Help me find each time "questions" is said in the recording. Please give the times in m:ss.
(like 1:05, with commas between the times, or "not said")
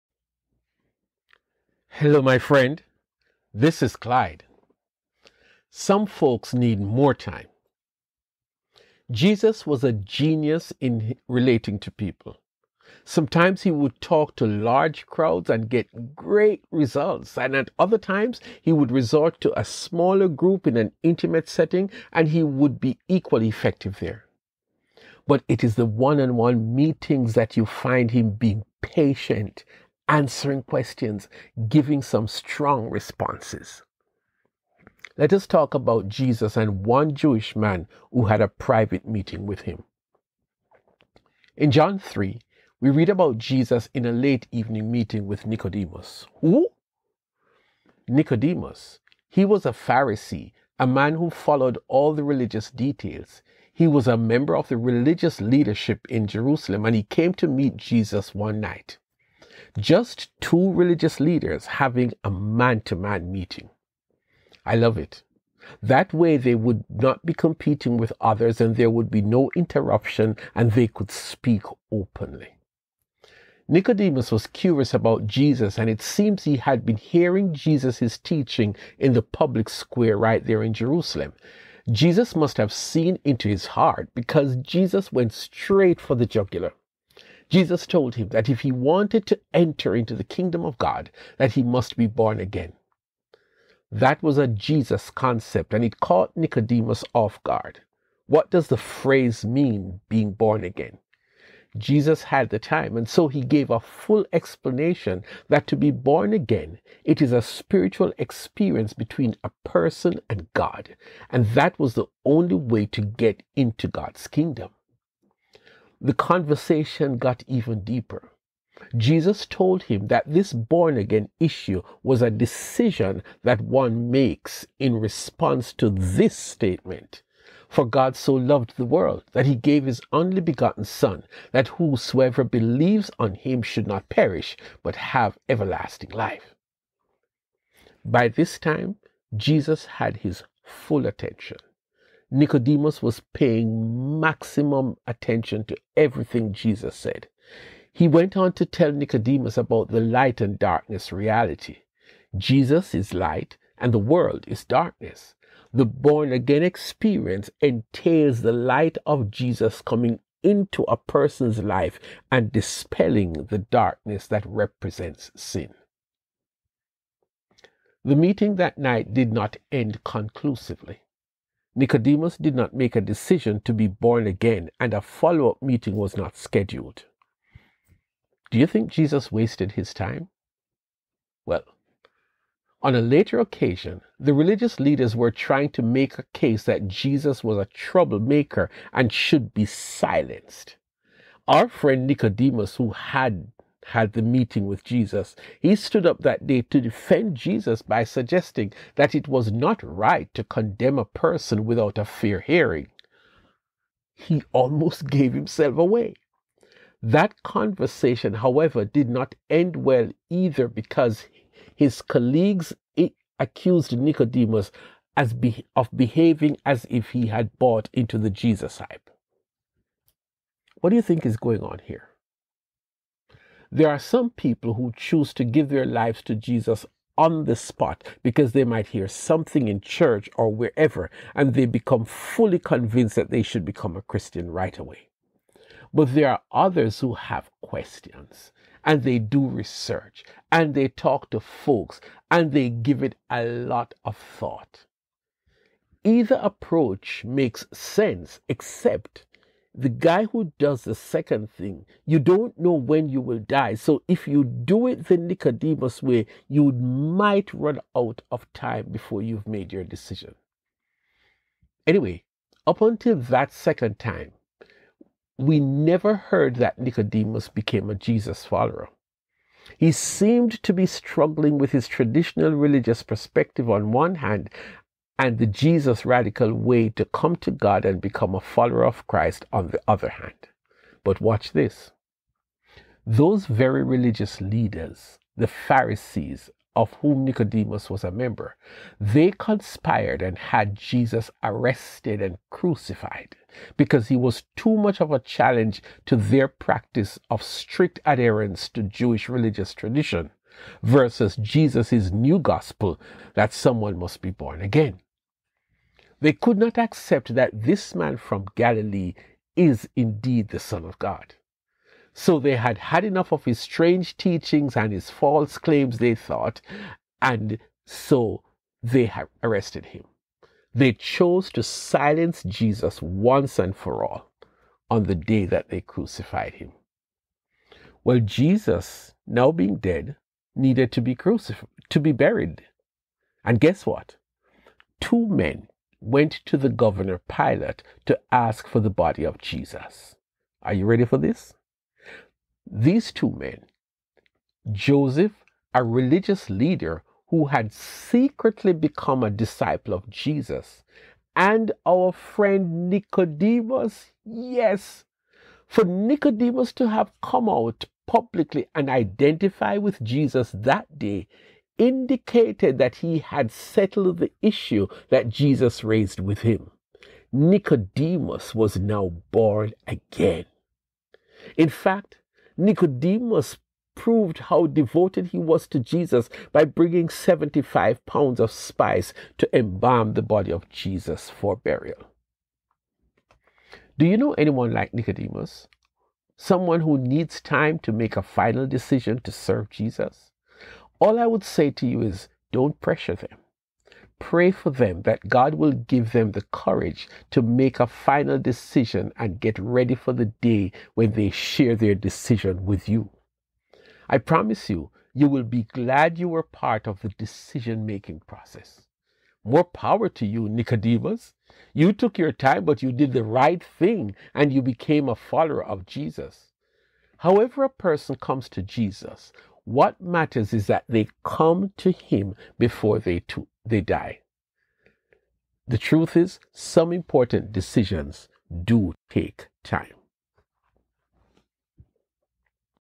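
0:30, 3:57.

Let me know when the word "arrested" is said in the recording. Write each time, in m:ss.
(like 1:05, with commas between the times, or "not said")
4:51, 5:19.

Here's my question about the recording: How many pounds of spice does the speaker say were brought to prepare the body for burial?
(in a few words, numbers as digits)
75.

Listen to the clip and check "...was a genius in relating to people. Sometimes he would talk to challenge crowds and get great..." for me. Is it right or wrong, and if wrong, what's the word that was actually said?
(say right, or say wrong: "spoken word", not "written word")
wrong: "large", not "challenge".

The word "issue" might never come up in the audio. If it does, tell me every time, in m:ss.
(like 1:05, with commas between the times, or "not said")
2:01, 6:04.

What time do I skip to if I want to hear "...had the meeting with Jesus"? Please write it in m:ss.
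3:13.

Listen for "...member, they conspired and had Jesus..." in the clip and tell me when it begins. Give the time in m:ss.
4:48.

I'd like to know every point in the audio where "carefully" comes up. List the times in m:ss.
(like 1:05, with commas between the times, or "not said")
not said.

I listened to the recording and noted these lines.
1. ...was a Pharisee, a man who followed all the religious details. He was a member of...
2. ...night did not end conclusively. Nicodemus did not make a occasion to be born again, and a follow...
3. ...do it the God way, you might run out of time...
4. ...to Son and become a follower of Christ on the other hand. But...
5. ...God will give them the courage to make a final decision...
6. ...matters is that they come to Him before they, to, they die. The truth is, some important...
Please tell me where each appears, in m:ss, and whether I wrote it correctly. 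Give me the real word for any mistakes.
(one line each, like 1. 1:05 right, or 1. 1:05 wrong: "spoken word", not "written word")
1. 0:49 right
2. 2:48 wrong: "decision", not "occasion"
3. 4:14 wrong: "Nicodemus", not "God"
4. 4:37 wrong: "God", not "Son"
5. 6:35 right
6. 7:00 right.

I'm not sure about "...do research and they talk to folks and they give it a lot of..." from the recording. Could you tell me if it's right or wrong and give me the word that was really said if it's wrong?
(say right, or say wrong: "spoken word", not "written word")
right.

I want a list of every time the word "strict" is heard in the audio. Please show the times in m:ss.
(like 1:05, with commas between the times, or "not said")
4:57.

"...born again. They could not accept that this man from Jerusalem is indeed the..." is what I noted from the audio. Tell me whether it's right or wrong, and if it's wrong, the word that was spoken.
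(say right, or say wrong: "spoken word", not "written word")
wrong: "Galilee", not "Jerusalem".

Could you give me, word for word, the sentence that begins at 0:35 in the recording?
Let us talk about Jesus and one Jewish man who had a private meeting with him.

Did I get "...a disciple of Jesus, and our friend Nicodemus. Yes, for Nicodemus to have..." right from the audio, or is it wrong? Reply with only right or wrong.
right.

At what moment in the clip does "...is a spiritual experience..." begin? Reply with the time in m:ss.
1:47.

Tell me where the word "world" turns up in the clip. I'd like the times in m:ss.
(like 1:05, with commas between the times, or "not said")
2:08, 2:33.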